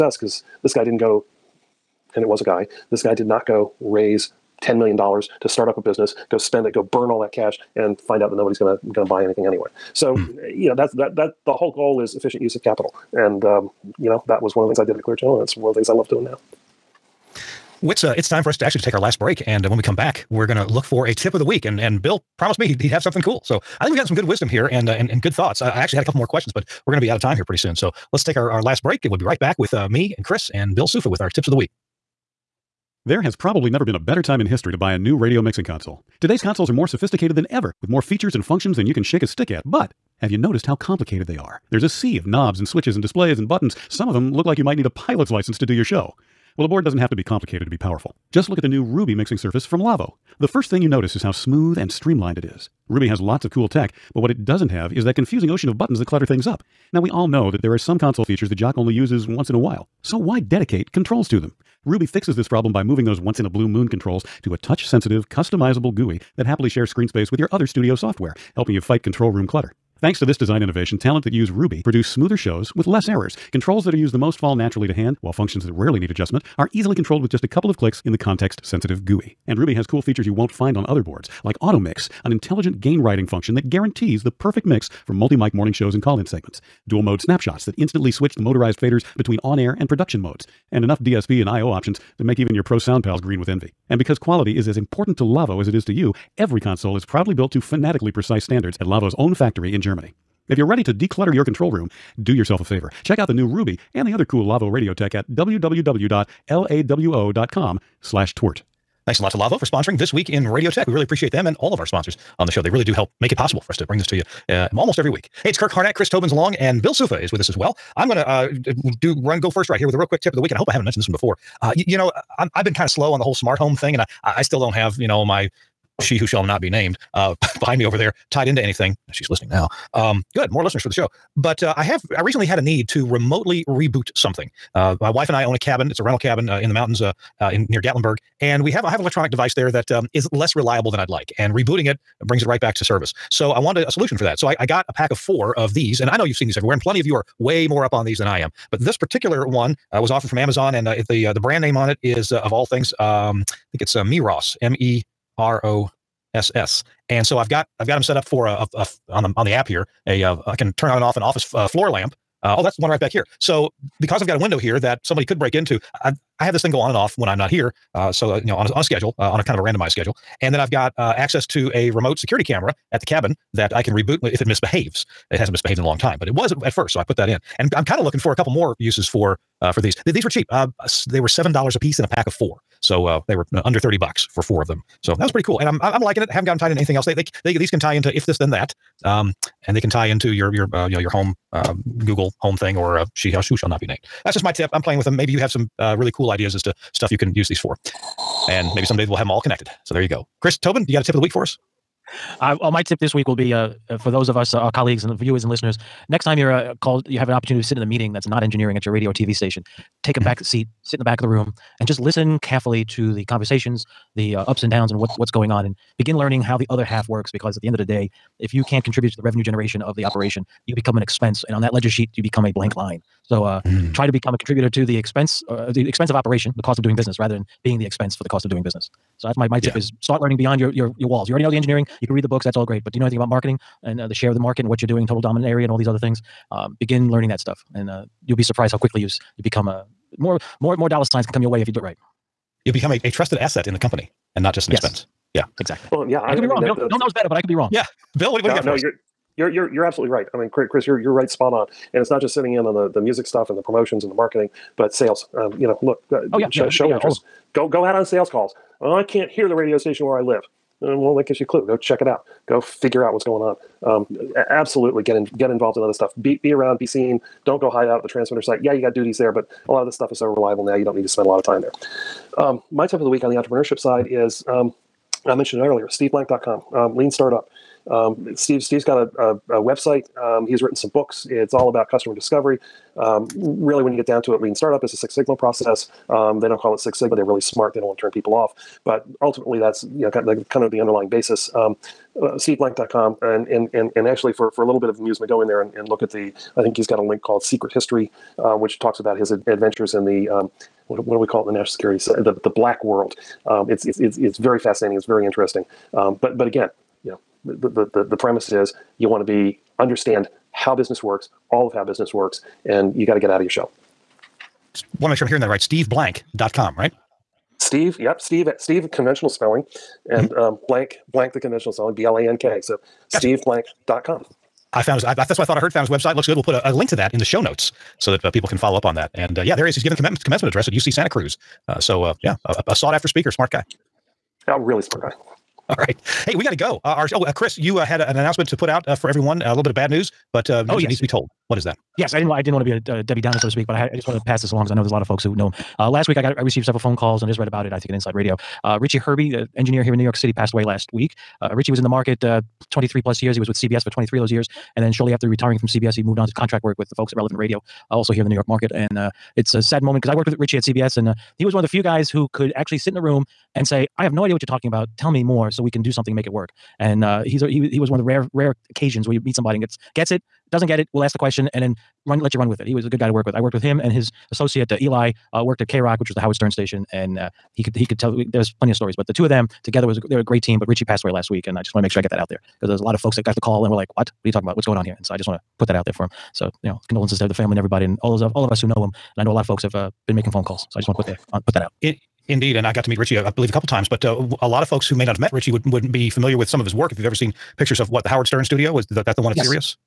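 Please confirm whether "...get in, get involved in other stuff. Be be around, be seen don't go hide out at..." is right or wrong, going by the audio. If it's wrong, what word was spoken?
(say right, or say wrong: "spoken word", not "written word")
right.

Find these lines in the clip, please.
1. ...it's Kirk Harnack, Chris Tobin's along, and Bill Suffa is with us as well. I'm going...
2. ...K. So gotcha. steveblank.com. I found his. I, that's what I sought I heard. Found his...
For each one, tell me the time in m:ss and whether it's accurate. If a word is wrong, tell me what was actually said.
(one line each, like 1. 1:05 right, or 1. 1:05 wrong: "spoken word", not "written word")
1. 1:55 right
2. 5:22 wrong: "thought", not "sought".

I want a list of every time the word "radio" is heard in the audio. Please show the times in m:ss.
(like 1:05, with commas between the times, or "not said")
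0:35, 1:44, 1:50, 3:28, 4:19, 5:48, 5:57.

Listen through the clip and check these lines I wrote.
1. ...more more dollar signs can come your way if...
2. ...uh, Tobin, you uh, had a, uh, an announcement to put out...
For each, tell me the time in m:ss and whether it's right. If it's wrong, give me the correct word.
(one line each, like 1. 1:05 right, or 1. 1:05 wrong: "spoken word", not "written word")
1. 4:00 right
2. 5:37 wrong: "Chris", not "Tobin".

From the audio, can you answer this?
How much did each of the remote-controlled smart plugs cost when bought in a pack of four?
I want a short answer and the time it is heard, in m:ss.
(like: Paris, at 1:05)
$7, at 3:01.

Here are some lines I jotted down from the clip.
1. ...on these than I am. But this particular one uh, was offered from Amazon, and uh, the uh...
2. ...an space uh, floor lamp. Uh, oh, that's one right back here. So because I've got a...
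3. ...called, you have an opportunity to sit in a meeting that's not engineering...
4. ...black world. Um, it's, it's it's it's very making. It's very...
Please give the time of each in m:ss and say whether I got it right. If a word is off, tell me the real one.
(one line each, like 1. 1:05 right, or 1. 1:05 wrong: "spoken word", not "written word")
1. 2:27 right
2. 2:41 wrong: "office", not "space"
3. 3:26 right
4. 5:02 wrong: "fascinating", not "making".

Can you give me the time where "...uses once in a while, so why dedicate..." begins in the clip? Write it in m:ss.
0:58.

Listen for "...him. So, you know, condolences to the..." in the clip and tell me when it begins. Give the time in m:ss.
6:26.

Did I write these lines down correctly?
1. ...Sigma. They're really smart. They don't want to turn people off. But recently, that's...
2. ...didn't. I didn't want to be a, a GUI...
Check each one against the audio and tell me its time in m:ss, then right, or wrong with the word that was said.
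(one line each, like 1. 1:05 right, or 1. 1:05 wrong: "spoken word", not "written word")
1. 4:46 wrong: "ultimately", not "recently"
2. 5:42 wrong: "Debbie", not "GUI".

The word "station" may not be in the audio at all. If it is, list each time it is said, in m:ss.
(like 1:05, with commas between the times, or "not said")
3:29, 4:19, 6:16.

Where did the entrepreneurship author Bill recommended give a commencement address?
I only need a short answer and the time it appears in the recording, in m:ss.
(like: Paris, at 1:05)
UC Santa Cruz, at 5:30.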